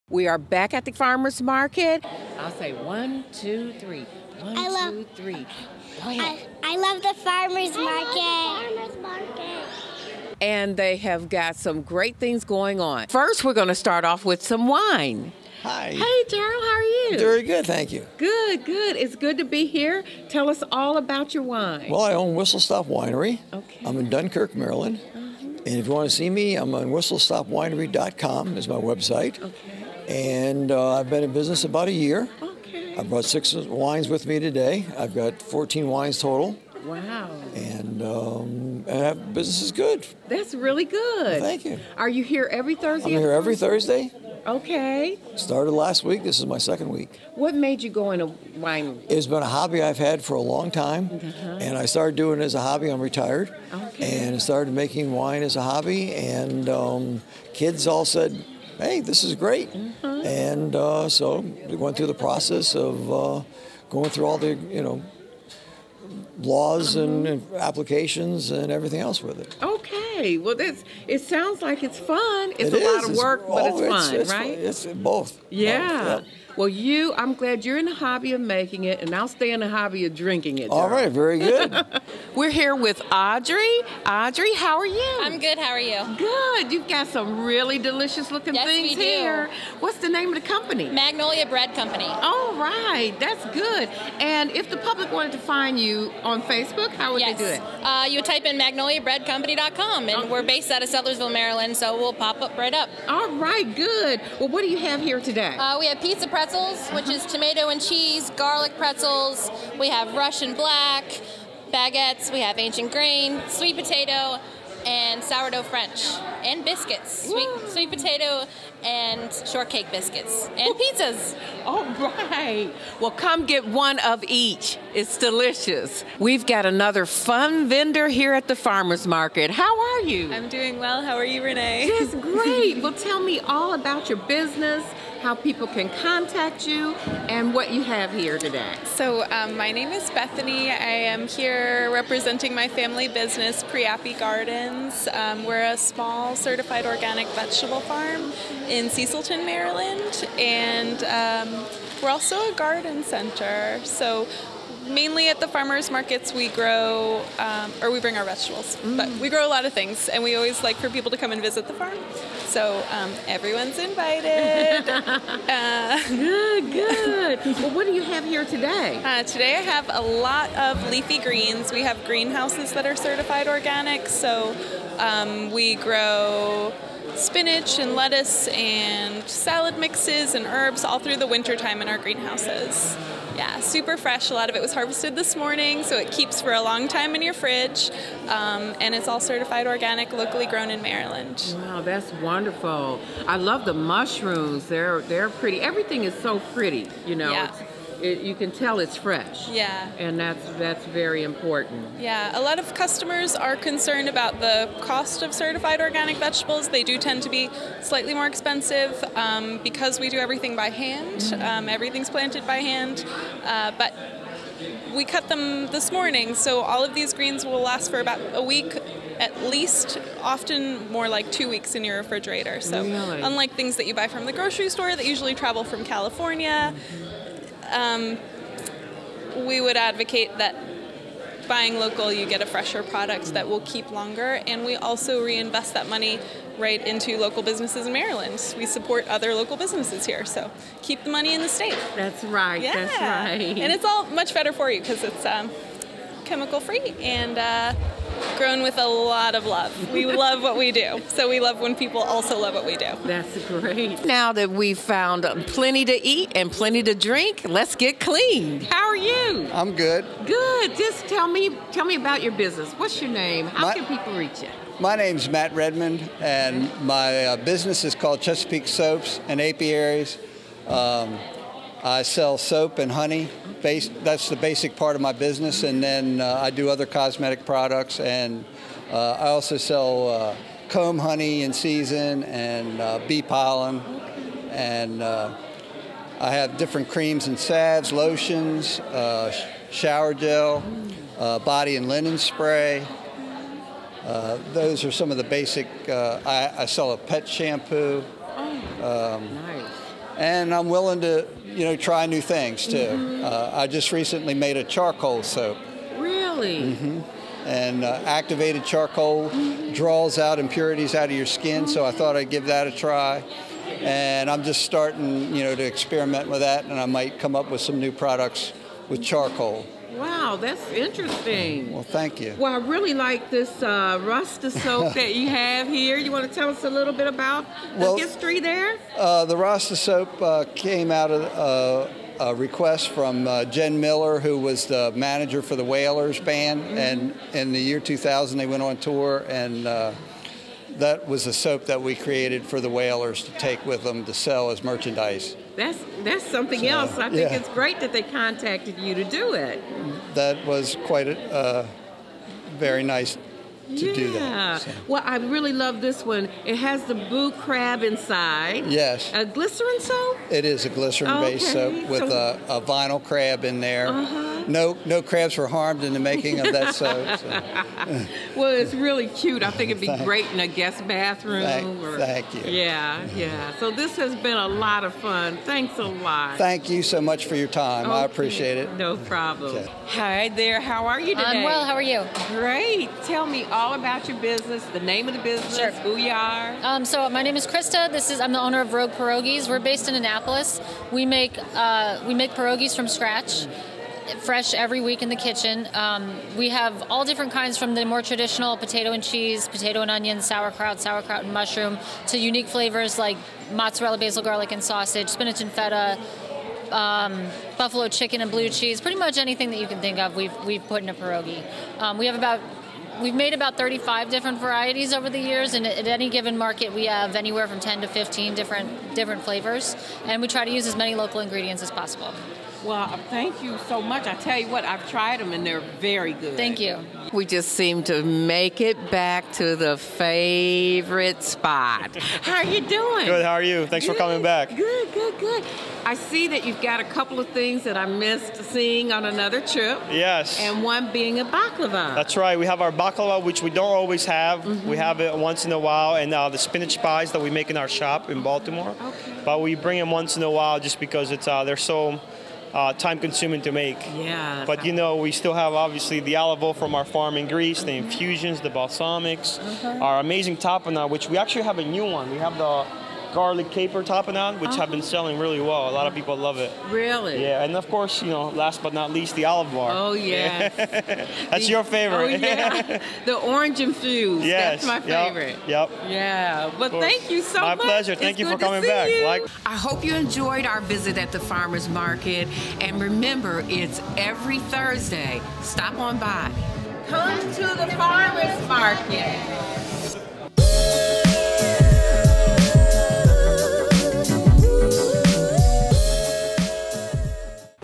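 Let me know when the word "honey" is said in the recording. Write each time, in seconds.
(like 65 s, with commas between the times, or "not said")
272 s, 280 s.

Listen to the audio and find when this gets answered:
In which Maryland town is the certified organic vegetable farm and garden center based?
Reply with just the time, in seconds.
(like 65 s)
148 s.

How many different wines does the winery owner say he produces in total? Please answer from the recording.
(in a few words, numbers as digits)
14.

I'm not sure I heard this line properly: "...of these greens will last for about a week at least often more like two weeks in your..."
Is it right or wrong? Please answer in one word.
right.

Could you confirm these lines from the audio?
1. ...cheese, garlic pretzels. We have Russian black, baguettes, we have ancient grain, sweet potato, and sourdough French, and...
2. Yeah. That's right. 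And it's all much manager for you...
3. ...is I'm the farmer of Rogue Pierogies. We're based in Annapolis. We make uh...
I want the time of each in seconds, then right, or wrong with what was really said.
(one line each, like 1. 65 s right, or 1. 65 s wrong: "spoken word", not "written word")
1. 107 s right
2. 242 s wrong: "better", not "manager"
3. 388 s wrong: "owner", not "farmer".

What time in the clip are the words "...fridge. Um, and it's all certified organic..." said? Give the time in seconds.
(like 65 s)
187 s.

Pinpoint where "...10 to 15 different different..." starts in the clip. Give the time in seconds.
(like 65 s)
417 s.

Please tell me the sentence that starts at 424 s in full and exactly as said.
I tell you what, I've tried them and they're very good.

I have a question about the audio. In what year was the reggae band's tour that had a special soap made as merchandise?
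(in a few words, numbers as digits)
2000.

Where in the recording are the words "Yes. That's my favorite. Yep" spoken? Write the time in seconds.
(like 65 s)
474 s.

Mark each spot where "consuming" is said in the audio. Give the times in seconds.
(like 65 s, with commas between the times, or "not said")
452 s.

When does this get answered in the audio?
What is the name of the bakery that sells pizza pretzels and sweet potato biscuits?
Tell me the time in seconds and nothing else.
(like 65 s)
90 s.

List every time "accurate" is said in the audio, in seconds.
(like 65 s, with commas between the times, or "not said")
not said.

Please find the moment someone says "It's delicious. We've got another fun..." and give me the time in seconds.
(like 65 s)
124 s.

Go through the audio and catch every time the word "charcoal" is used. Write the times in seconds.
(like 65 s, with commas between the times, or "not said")
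304 s, 308 s, 319 s.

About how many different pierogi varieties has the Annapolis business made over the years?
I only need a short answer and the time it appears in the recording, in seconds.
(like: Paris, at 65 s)
35, at 413 s.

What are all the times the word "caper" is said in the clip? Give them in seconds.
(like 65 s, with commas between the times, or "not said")
463 s.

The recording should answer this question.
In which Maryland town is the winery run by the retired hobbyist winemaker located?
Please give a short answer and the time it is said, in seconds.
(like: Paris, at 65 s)
Dunkirk, at 24 s.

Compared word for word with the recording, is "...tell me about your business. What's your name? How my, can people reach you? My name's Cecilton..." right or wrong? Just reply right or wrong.
wrong.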